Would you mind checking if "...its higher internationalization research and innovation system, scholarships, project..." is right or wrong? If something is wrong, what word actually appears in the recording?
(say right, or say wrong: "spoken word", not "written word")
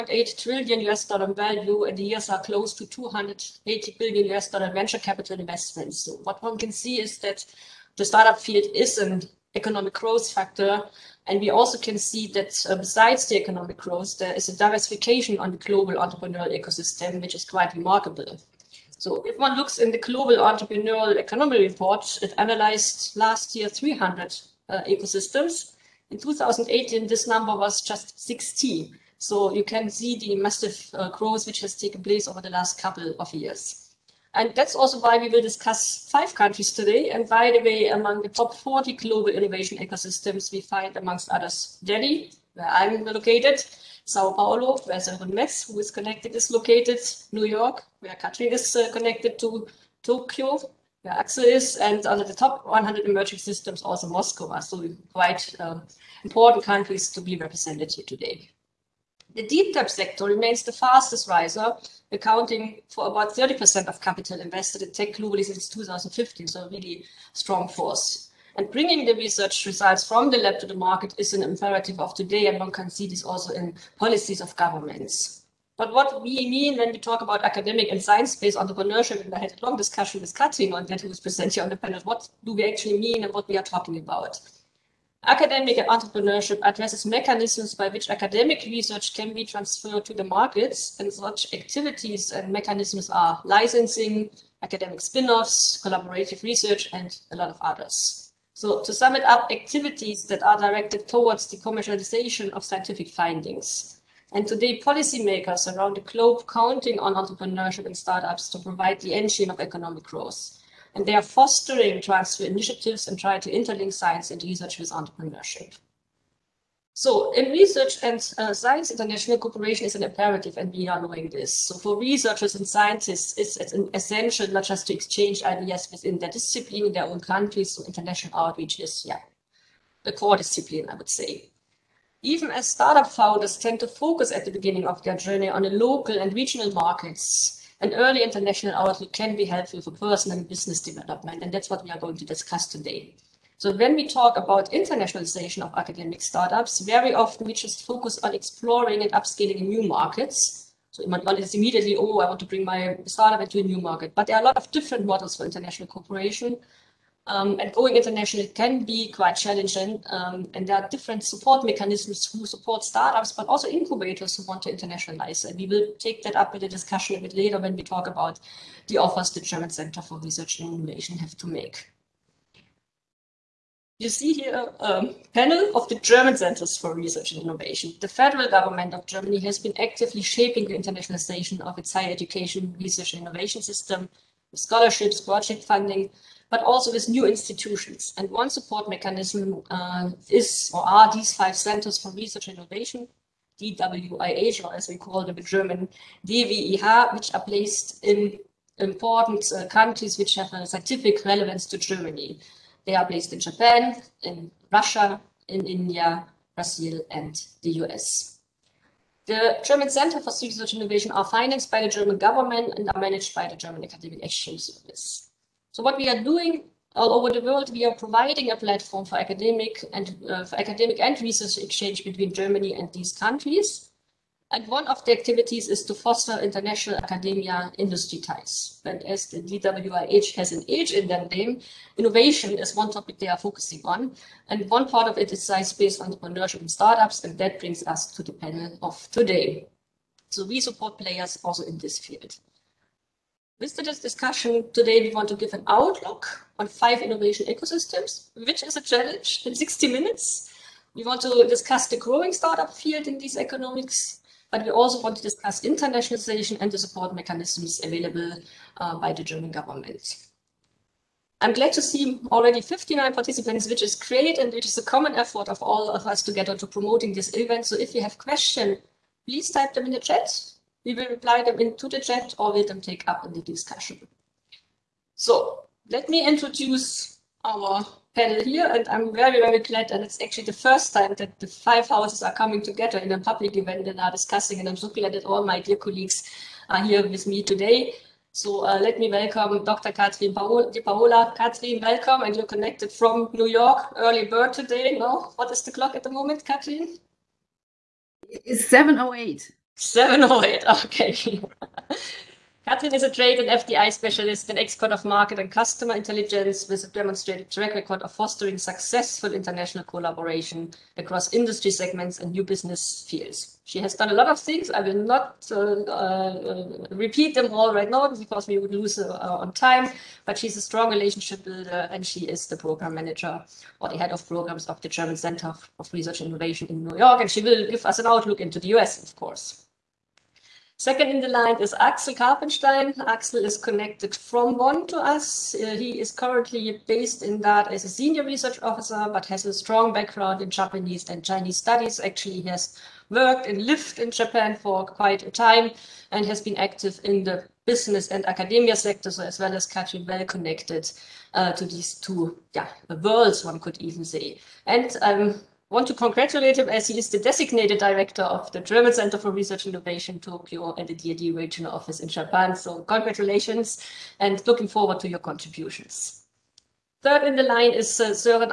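wrong: "education", not "internationalization".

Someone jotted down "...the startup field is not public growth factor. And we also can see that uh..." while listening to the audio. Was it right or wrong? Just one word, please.
wrong.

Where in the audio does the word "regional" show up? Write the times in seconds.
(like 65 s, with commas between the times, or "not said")
136 s, 361 s.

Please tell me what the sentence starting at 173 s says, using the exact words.
You see here a panel of the German Centers for Research and Innovation.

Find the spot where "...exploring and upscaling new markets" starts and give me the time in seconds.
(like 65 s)
148 s.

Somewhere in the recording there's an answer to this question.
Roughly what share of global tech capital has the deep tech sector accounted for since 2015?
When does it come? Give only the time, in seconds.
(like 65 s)
63 s.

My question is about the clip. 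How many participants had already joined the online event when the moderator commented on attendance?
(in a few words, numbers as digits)
59.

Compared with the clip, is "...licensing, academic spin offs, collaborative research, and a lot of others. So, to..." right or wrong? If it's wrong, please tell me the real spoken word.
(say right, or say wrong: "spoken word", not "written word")
right.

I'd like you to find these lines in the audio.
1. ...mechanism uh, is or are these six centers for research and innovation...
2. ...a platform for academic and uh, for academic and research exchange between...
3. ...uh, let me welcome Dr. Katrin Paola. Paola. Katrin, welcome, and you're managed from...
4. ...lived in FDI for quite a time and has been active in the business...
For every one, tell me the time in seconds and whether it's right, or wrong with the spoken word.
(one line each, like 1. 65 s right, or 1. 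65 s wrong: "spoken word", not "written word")
1. 188 s wrong: "five", not "six"
2. 218 s right
3. 288 s wrong: "connected", not "managed"
4. 343 s wrong: "Japan", not "FDI".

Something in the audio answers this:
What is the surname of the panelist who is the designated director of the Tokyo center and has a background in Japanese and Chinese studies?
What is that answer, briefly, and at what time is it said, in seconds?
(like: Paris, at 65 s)
Karpenstein, at 332 s.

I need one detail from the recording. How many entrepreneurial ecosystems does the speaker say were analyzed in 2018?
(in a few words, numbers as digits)
16.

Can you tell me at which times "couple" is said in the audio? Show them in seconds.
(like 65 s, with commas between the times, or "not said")
32 s.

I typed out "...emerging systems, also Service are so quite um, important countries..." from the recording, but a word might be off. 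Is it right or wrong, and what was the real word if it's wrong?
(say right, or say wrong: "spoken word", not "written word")
wrong: "Moscow", not "Service".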